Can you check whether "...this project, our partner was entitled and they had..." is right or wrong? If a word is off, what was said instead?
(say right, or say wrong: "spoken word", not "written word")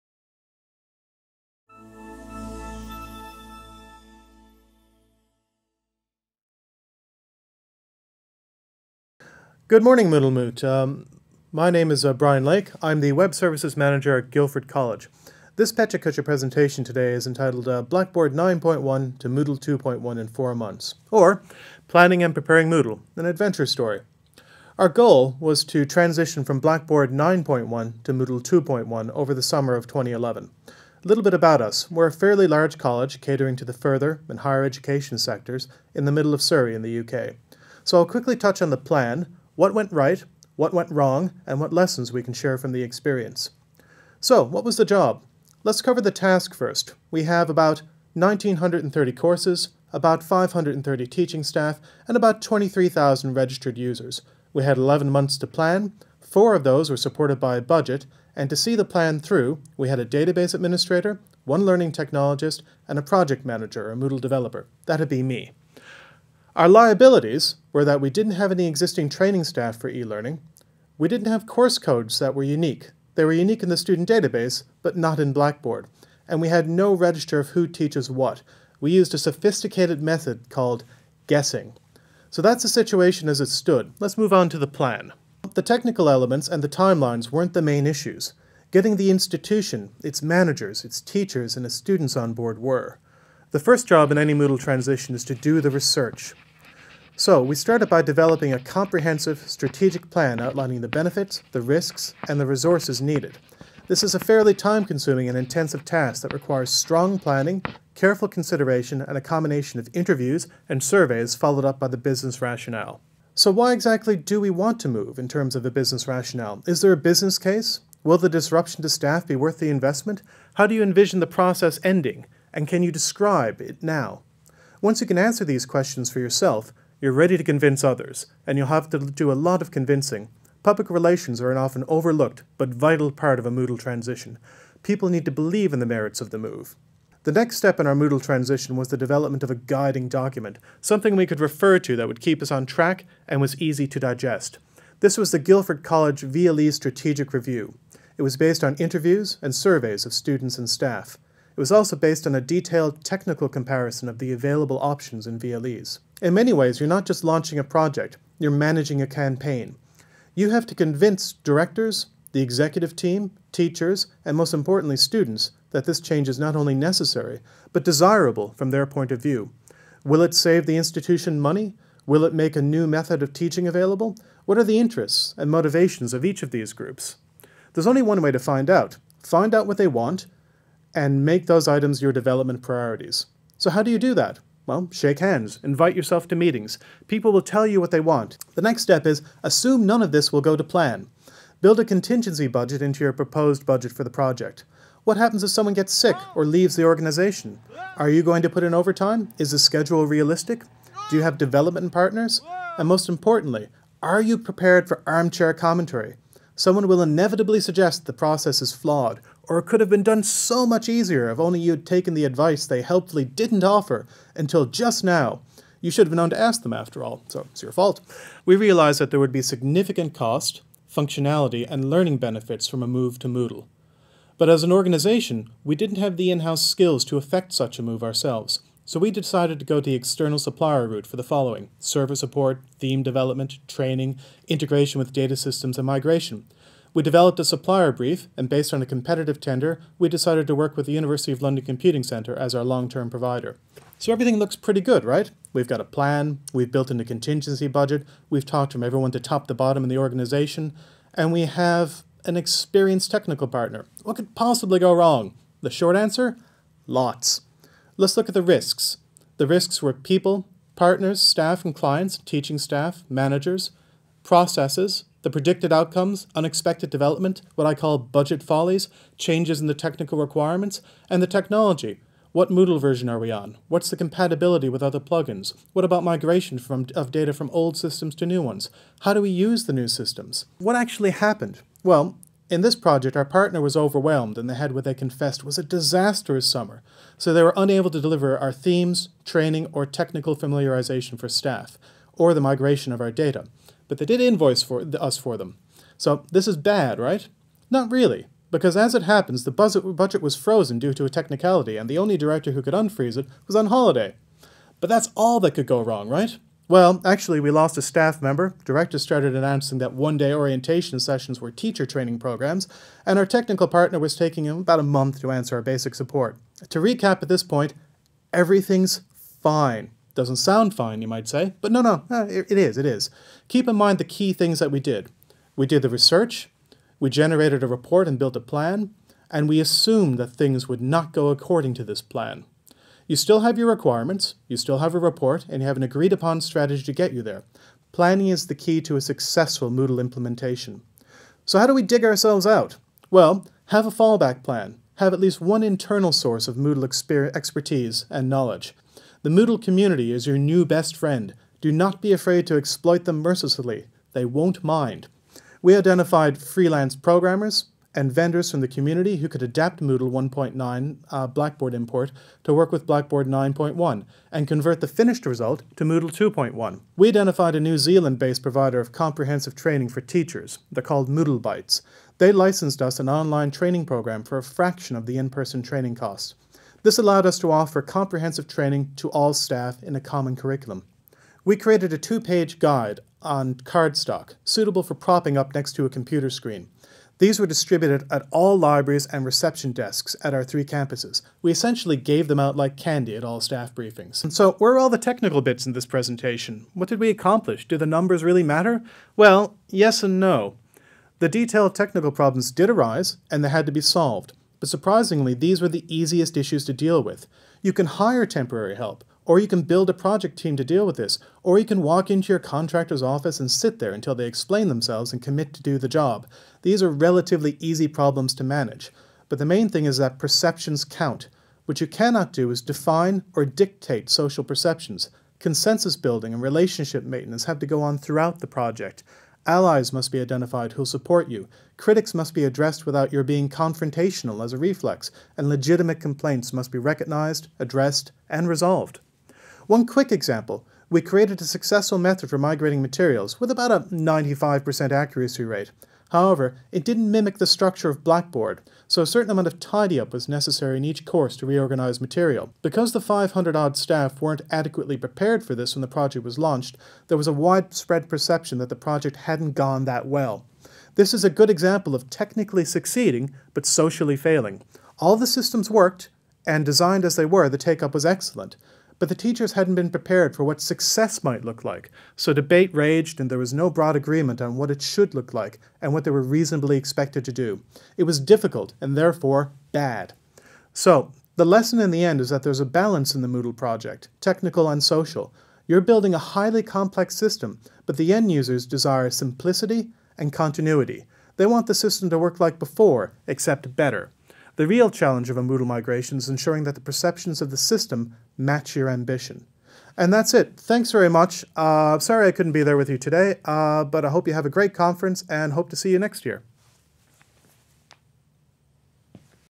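wrong: "overwhelmed", not "entitled".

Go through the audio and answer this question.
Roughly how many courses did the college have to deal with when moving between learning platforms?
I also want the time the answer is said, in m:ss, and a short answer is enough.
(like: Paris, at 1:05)
1,930, at 0:48.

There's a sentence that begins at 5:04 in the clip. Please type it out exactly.
But that's all that could go wrong, right?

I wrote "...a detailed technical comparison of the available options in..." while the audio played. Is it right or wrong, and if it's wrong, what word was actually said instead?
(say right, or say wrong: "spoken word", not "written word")
right.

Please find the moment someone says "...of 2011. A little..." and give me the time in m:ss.
0:29.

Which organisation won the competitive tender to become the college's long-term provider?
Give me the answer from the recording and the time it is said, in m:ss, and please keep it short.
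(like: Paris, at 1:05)
University of London Computing Centre, at 4:00.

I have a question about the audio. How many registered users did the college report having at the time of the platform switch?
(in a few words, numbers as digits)
23,000.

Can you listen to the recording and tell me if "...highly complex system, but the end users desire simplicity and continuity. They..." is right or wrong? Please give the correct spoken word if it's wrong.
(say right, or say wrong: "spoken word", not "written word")
right.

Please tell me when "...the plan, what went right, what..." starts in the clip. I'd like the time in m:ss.
0:38.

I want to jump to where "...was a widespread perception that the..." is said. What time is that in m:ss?
7:37.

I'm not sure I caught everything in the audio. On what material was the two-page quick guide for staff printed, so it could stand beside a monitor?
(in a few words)
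cardstock.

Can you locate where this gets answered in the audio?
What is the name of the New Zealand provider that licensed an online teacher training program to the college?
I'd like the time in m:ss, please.
6:11.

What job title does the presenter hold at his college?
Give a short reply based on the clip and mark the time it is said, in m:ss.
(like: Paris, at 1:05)
Web Services Manager, at 0:13.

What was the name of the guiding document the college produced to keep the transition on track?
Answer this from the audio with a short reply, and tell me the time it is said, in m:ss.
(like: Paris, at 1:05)
Guildford College VLE Strategic Review, at 2:25.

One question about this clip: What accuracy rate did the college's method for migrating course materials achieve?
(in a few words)
95%.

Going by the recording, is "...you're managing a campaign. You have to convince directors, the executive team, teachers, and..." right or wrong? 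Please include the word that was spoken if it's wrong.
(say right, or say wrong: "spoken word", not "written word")
right.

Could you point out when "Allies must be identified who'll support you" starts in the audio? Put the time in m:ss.
7:09.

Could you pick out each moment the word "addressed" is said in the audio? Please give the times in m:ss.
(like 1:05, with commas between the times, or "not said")
7:12, 7:17.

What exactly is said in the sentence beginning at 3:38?
We realized that there would be significant cost, functionality, and learning benefits from a move to Moodle.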